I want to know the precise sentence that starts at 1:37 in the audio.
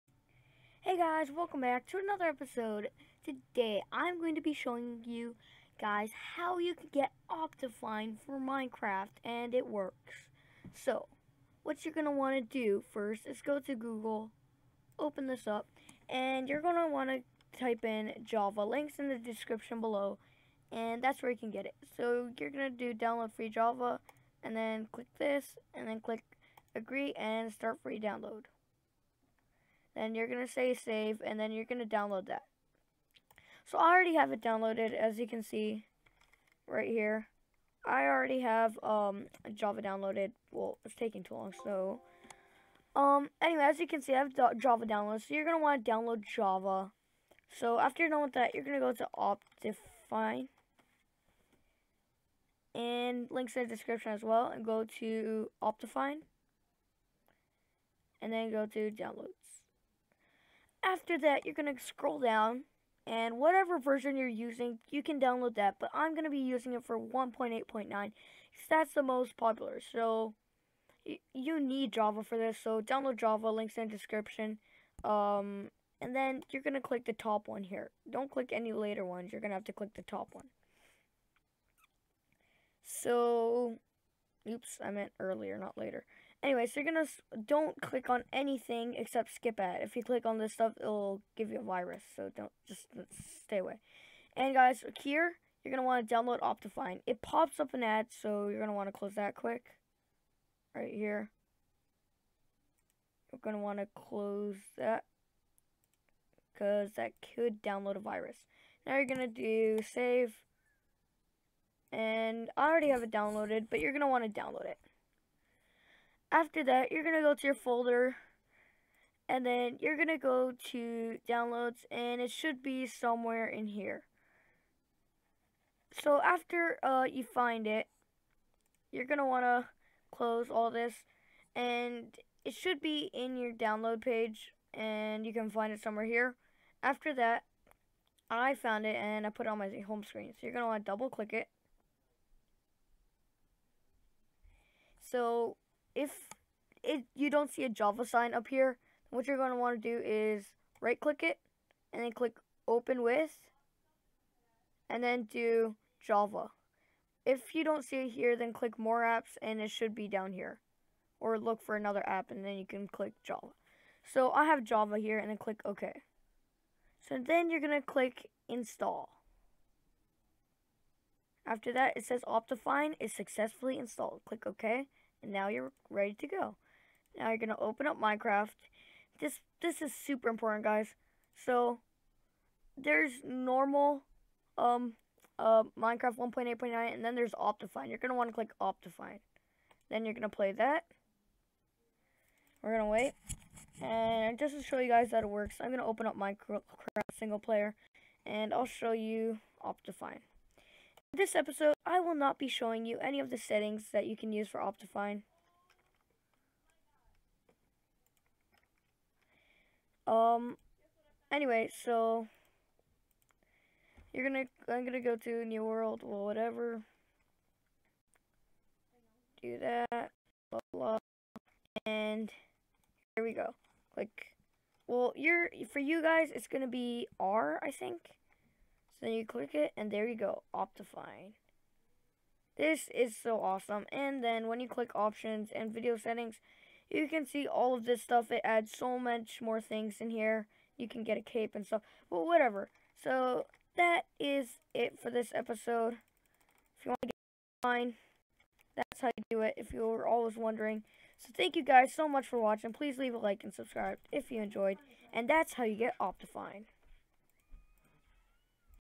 It pops up an ad, so you're gonna want to close that quick.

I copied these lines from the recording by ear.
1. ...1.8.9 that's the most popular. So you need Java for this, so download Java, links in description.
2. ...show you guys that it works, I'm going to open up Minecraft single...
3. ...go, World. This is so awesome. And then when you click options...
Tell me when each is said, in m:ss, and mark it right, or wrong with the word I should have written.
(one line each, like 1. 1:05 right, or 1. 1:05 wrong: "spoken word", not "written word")
1. 1:06 right
2. 3:14 right
3. 3:50 wrong: "Optifine", not "World".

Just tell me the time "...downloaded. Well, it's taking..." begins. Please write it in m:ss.
0:39.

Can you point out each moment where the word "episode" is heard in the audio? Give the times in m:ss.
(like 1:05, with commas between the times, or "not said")
0:02, 3:21, 4:05.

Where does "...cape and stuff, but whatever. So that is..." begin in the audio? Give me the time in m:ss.
4:01.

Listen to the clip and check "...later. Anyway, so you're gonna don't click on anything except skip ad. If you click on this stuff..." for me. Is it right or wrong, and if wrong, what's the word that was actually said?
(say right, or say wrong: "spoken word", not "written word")
right.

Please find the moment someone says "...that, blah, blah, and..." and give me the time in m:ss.
3:39.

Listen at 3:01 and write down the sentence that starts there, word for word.
So there's normal um uh, Minecraft 1.8.9 and then there's Optifine.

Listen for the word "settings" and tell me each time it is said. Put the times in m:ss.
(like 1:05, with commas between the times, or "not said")
3:23, 3:55.